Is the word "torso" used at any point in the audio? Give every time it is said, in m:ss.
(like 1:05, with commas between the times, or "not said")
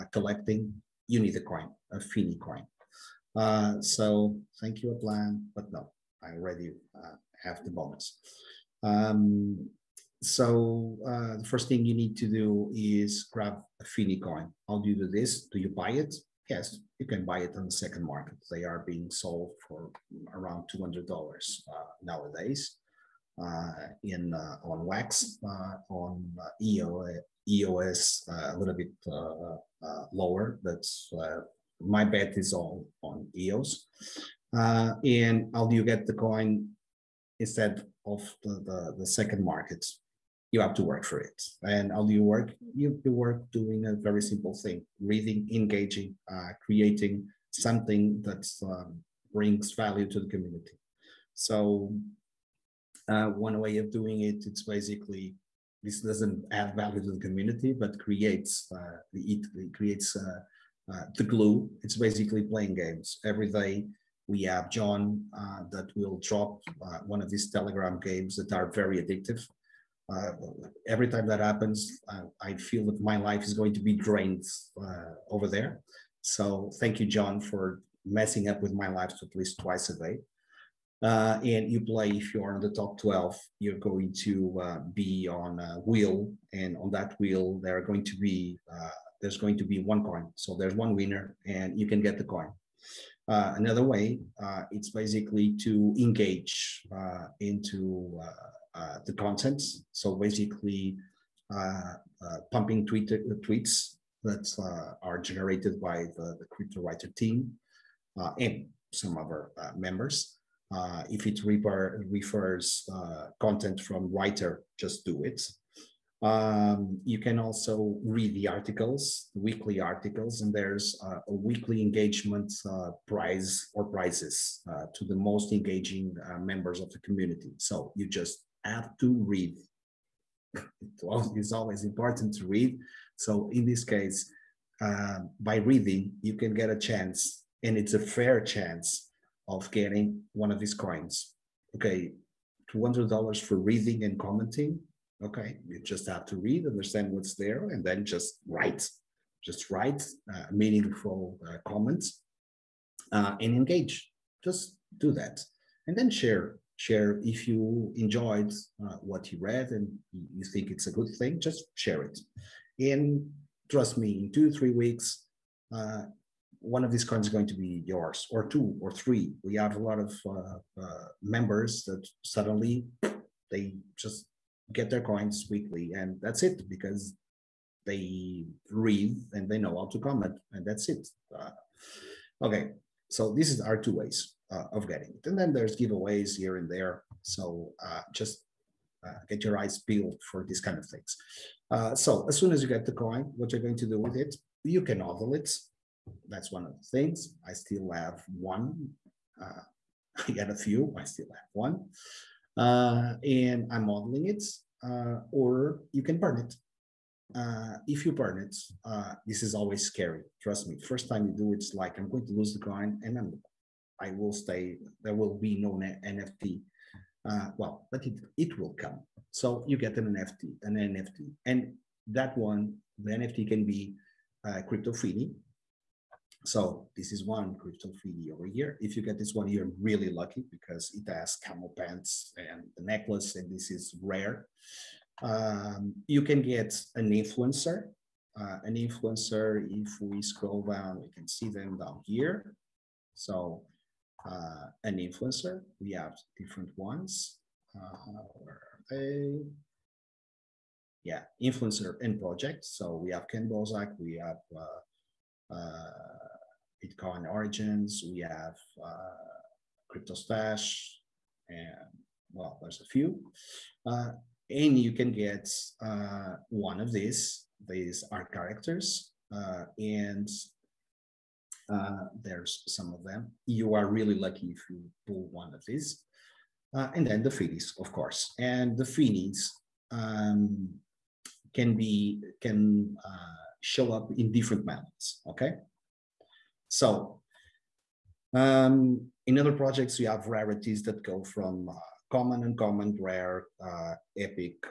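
not said.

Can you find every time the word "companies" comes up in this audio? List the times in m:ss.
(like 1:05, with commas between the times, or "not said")
not said.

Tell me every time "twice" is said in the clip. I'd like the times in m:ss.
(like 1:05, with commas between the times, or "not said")
1:19.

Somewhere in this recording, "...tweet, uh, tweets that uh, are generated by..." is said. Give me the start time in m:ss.
1:42.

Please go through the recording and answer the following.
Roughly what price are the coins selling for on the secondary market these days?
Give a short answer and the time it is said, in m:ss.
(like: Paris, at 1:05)
$200, at 0:20.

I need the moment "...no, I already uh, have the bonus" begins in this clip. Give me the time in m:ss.
0:05.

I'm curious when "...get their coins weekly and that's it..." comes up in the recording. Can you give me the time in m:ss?
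2:54.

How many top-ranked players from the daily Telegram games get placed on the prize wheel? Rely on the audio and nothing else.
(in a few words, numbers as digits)
12.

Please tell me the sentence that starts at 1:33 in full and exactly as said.
another way, it's basically to engage into uh, the content.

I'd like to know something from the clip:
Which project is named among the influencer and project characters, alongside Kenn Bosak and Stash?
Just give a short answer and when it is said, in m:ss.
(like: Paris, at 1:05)
Bitcoin Origins, at 4:16.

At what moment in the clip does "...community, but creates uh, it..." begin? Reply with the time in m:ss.
0:57.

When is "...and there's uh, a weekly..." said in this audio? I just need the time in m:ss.
2:00.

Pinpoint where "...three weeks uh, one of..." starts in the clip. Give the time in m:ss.
2:44.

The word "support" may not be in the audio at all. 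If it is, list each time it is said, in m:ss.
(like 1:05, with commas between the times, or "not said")
not said.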